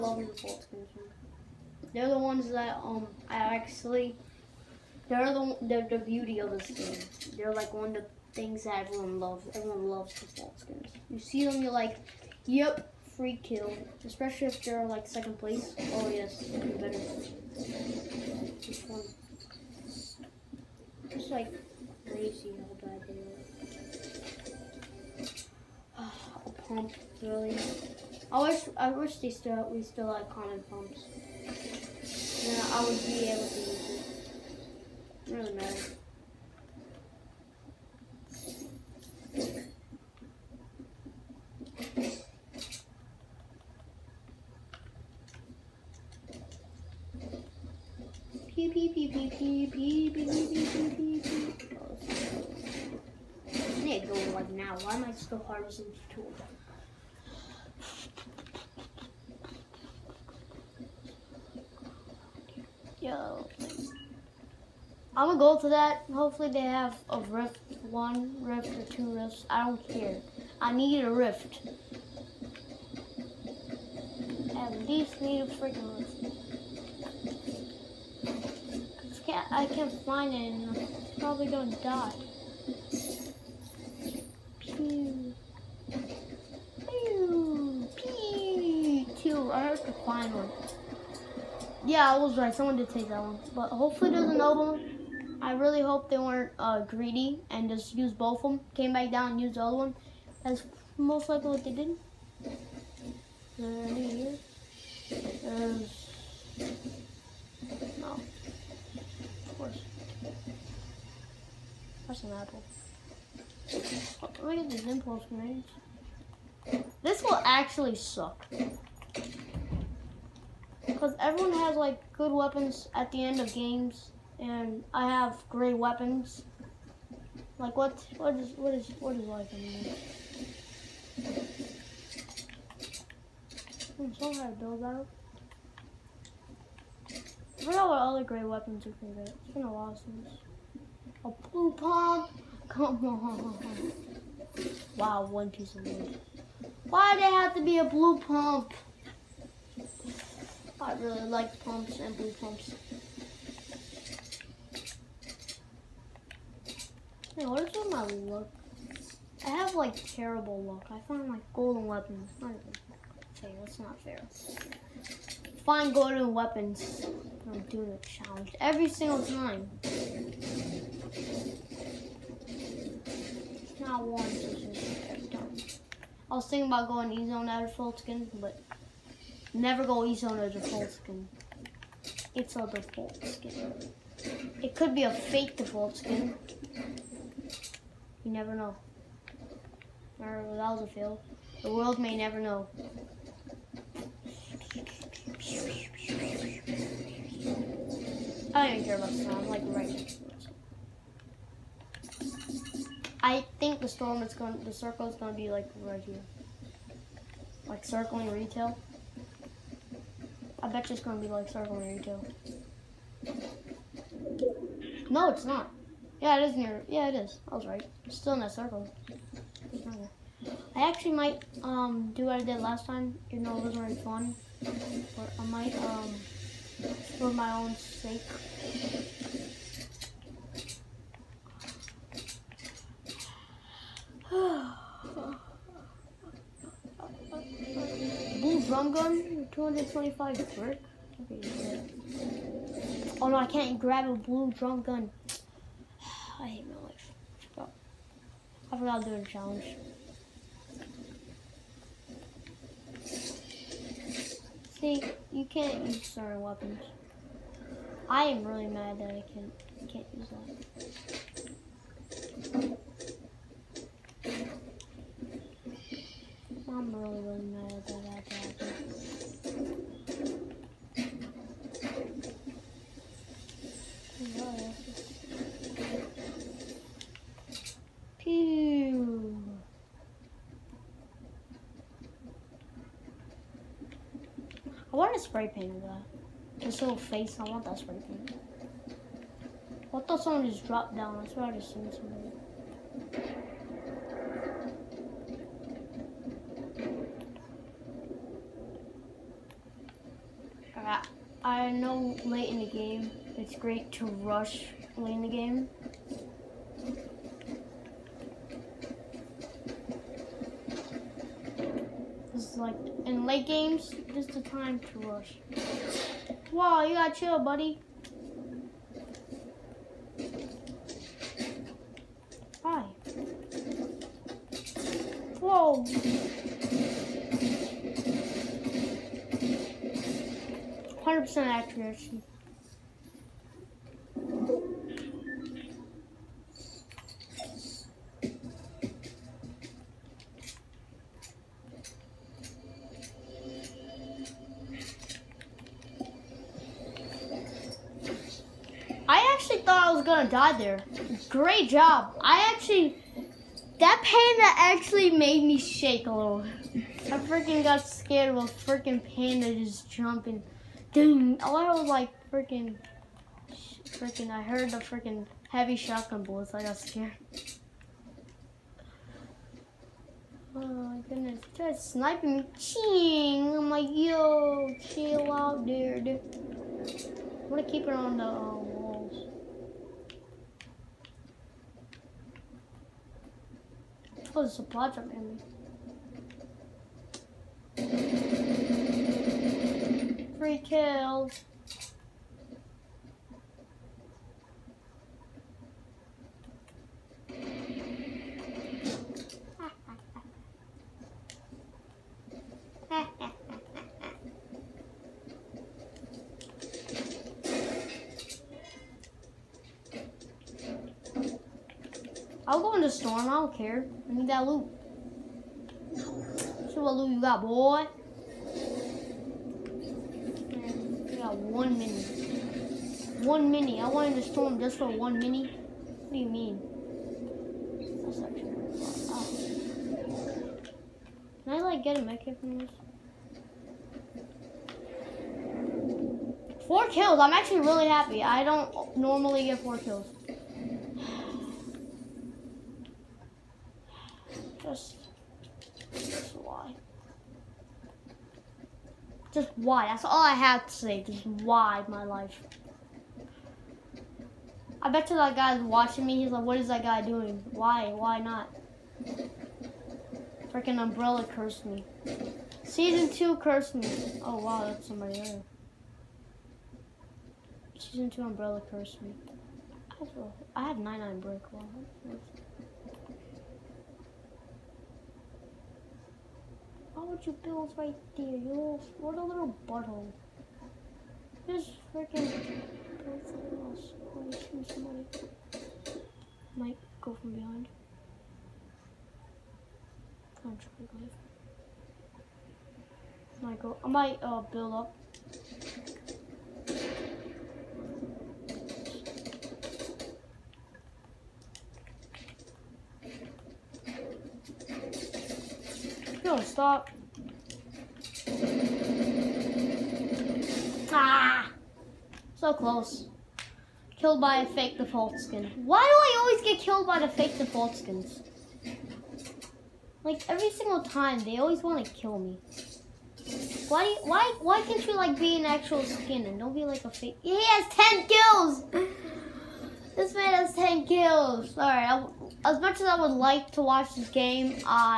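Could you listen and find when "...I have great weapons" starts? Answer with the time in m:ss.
2:04.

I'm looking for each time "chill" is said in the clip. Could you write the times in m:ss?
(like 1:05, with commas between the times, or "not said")
5:17, 6:14.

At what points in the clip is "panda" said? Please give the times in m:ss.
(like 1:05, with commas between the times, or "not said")
5:54, 5:59.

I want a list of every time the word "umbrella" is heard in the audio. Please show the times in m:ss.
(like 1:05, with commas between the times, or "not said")
7:40, 7:48.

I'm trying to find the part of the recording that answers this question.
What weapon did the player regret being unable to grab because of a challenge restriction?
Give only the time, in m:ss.
4:04.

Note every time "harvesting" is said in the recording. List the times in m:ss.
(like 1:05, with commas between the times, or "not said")
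0:55.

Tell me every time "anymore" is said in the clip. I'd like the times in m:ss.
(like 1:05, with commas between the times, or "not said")
2:09.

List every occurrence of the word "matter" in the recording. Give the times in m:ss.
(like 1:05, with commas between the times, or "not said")
0:35.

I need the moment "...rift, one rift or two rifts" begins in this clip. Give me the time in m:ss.
1:07.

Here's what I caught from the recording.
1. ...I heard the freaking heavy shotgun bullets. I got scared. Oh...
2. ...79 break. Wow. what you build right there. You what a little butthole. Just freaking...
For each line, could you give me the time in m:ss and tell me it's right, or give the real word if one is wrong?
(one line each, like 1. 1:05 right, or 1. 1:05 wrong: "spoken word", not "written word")
1. 6:04 right
2. 7:50 wrong: "99", not "79".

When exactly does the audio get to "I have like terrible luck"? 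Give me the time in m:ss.
2:39.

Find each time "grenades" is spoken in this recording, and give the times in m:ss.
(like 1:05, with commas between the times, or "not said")
1:55.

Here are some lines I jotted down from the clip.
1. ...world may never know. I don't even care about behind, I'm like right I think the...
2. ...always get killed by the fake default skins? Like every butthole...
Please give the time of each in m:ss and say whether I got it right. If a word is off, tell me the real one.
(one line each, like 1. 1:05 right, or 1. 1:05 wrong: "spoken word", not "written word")
1. 3:11 wrong: "sound", not "behind"
2. 8:36 wrong: "single", not "butthole".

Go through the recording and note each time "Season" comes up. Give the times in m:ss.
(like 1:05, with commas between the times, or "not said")
7:42, 7:47.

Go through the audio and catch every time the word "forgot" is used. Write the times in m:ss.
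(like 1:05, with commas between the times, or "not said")
2:17, 4:08.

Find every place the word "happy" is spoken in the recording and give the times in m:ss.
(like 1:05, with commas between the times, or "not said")
7:17.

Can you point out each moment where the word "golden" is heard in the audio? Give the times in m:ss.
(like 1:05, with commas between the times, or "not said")
2:41, 2:45.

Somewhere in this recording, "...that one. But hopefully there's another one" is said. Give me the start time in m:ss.
1:33.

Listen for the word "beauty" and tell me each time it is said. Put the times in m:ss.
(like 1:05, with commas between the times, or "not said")
0:05.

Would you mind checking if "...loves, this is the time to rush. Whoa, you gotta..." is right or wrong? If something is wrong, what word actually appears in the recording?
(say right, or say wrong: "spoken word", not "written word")
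wrong: "games", not "loves".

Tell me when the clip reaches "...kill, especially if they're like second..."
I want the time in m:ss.
0:13.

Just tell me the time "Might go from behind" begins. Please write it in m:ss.
8:06.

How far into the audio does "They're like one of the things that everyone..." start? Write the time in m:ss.
0:07.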